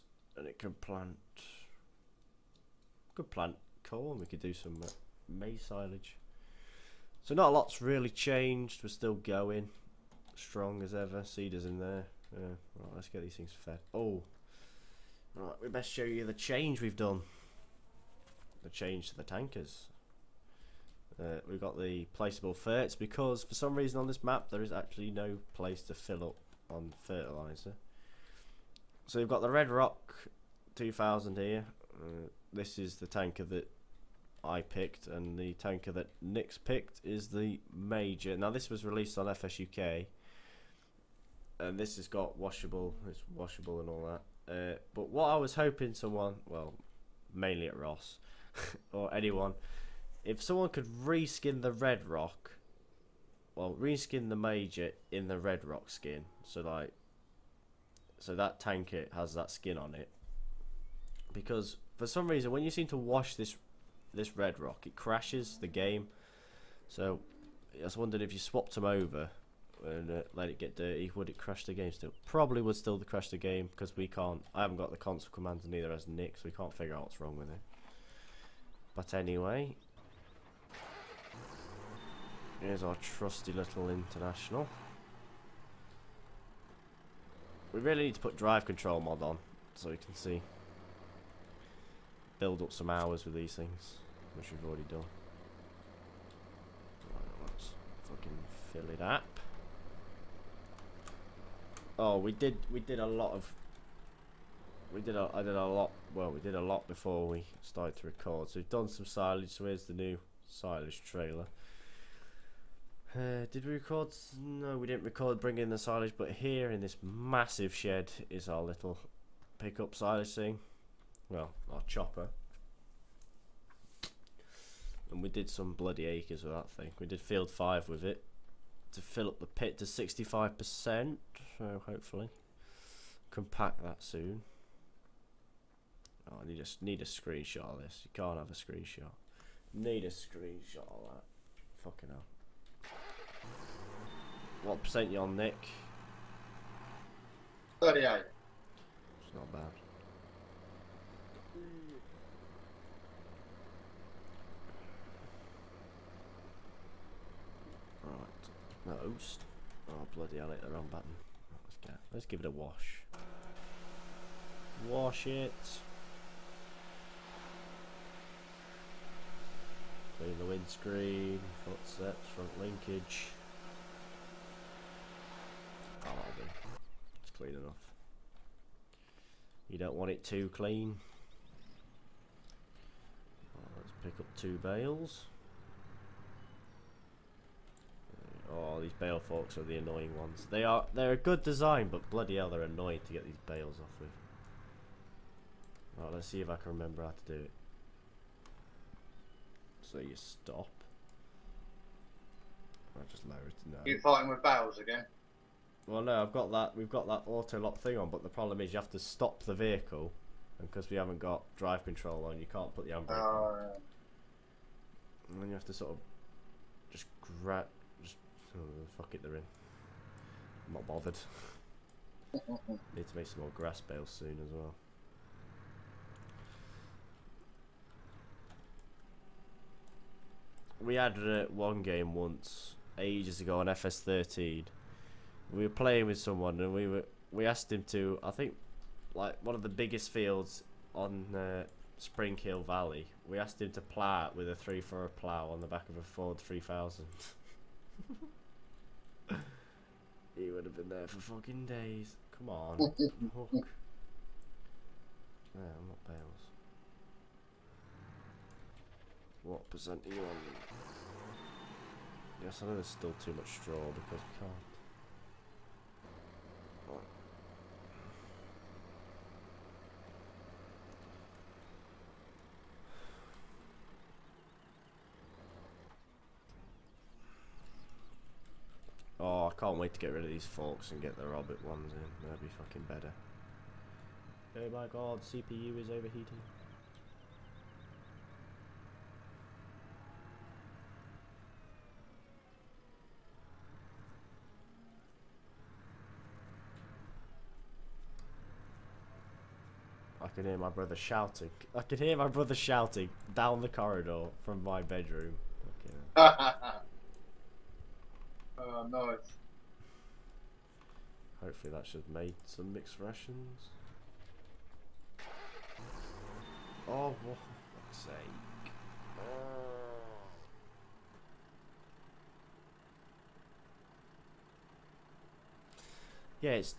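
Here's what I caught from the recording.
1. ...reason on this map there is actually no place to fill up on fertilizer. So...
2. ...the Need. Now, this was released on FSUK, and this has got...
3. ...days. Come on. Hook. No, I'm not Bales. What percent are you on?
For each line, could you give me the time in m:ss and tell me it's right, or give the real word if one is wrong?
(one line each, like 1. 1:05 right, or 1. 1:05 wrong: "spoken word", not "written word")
1. 0:23 right
2. 0:37 wrong: "Major", not "Need"
3. 4:11 right.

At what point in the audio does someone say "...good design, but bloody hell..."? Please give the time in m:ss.
3:11.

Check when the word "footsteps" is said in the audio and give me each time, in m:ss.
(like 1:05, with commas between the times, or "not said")
2:51.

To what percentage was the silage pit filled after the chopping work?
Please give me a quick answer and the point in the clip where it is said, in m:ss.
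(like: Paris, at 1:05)
65%, at 2:09.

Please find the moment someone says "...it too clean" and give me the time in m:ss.
3:00.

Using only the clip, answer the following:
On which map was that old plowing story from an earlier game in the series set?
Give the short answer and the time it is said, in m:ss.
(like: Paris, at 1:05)
Spring Hill Valley, at 4:01.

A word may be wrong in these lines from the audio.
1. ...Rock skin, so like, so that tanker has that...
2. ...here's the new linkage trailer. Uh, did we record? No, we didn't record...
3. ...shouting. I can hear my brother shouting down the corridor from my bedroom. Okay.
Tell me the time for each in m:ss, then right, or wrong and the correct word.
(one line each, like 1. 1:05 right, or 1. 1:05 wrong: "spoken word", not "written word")
1. 0:55 right
2. 1:49 wrong: "silage", not "linkage"
3. 5:00 right.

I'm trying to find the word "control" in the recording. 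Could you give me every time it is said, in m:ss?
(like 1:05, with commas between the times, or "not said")
1:28, 3:31.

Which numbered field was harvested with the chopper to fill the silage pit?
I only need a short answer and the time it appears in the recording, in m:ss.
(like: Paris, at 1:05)
Field 5, at 2:07.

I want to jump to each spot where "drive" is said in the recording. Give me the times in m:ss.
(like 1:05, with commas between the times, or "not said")
1:28, 3:31.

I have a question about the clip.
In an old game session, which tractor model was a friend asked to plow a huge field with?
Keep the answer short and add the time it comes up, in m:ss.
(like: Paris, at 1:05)
Ford 3000, at 4:06.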